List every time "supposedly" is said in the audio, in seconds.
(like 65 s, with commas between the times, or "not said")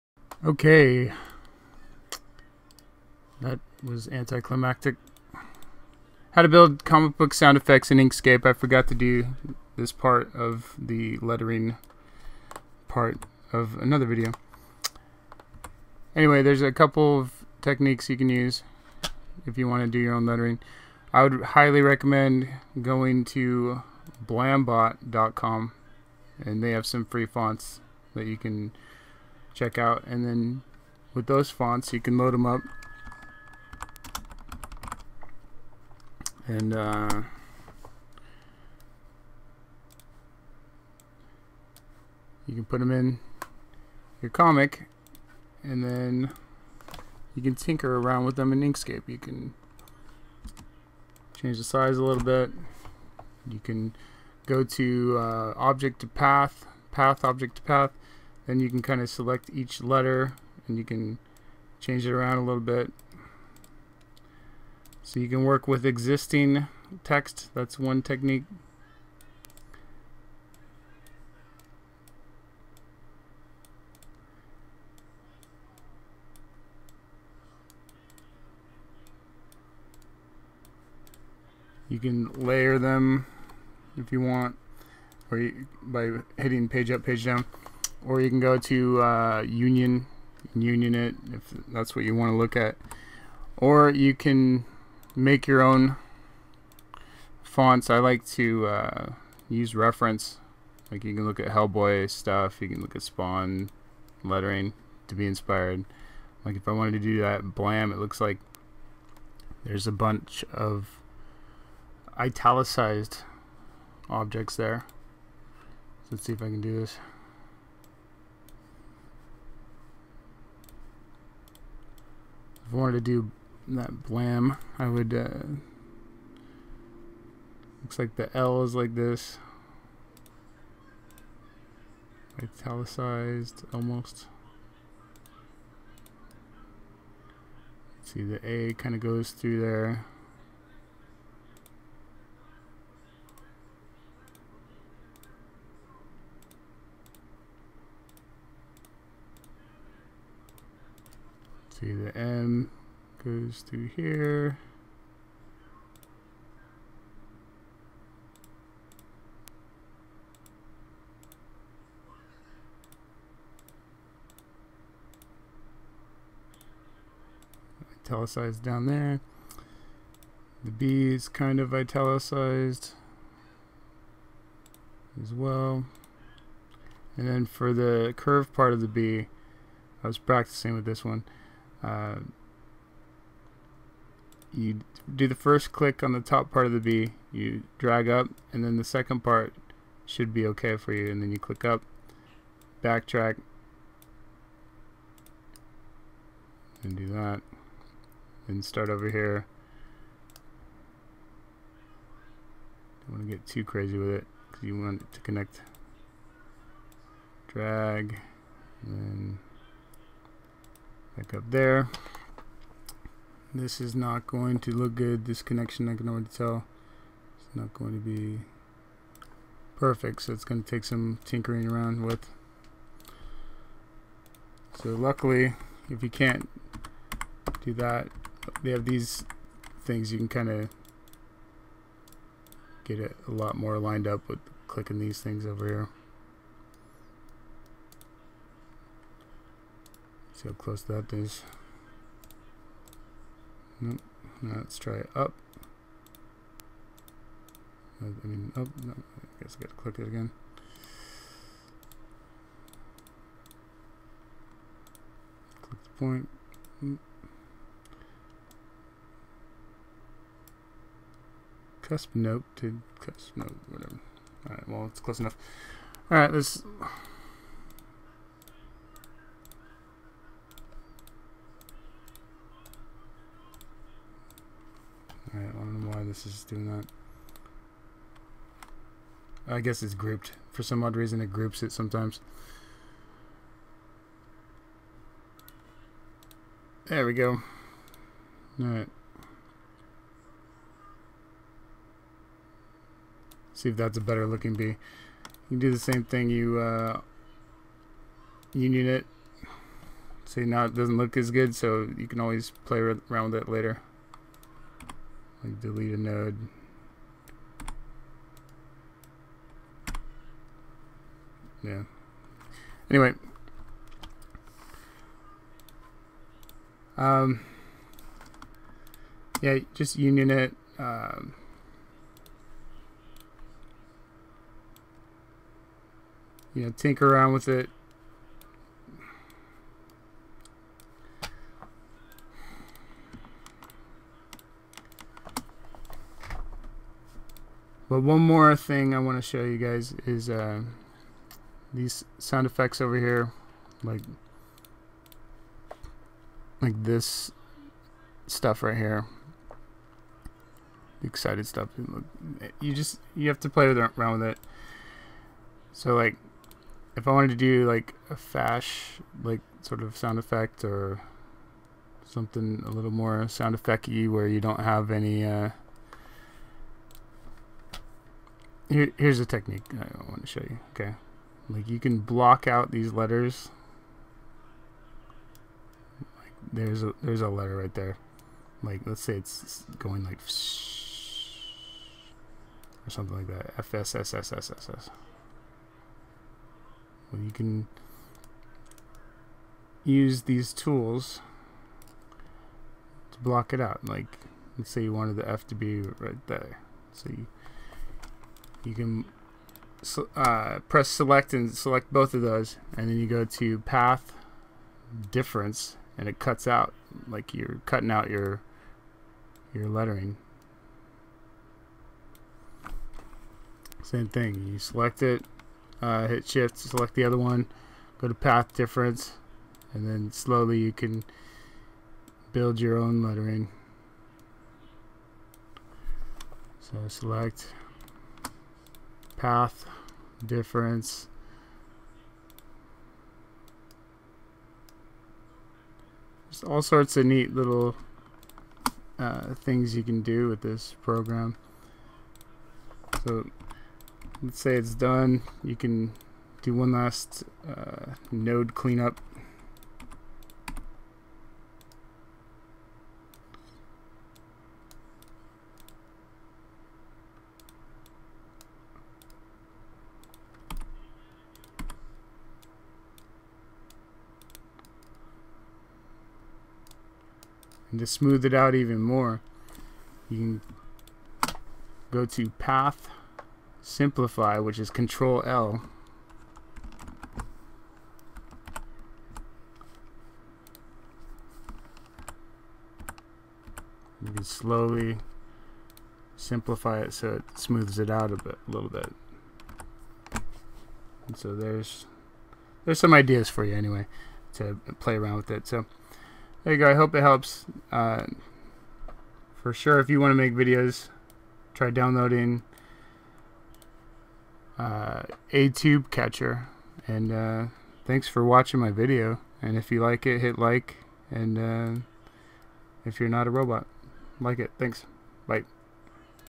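not said.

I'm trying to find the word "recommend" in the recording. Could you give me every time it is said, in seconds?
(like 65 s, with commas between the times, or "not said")
21 s.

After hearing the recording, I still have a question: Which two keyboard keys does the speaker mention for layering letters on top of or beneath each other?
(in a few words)
Page Up, Page Down.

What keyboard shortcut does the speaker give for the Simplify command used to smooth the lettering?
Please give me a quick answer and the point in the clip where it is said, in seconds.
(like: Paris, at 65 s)
Control L, at 474 s.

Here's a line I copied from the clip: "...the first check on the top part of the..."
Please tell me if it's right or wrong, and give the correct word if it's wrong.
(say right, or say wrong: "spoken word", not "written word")
wrong: "click", not "check".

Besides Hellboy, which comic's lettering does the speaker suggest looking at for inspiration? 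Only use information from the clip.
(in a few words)
Spawn.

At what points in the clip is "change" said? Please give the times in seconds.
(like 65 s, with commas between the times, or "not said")
51 s, 61 s.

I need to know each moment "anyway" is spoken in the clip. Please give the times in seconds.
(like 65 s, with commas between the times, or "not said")
16 s, 312 s, 493 s.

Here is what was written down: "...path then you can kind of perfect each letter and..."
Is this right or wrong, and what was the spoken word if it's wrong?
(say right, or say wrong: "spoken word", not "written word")
wrong: "select", not "perfect".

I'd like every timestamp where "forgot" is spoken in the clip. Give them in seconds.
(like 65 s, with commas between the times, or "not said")
8 s.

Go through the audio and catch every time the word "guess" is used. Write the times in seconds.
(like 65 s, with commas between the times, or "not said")
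249 s, 279 s.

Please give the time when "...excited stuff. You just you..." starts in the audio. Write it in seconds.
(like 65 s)
351 s.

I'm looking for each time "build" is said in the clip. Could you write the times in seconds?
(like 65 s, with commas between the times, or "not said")
6 s, 422 s.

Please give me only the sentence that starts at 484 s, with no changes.
You can slowly simplify it so it smooths it out a bit, a little bit.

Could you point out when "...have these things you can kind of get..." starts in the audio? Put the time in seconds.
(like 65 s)
228 s.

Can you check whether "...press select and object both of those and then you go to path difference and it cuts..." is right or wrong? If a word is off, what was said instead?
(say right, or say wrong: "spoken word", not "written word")
wrong: "select", not "object".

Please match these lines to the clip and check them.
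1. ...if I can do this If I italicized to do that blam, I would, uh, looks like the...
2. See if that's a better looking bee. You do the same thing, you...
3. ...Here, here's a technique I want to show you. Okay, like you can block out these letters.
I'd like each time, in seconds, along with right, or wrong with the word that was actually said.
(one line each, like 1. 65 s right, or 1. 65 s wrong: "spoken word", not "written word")
1. 116 s wrong: "wanted", not "italicized"
2. 293 s right
3. 368 s right.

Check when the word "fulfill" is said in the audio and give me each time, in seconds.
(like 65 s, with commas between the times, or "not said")
not said.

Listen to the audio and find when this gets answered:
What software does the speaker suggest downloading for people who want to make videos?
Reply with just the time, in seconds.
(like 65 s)
505 s.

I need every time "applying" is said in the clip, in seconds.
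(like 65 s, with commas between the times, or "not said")
not said.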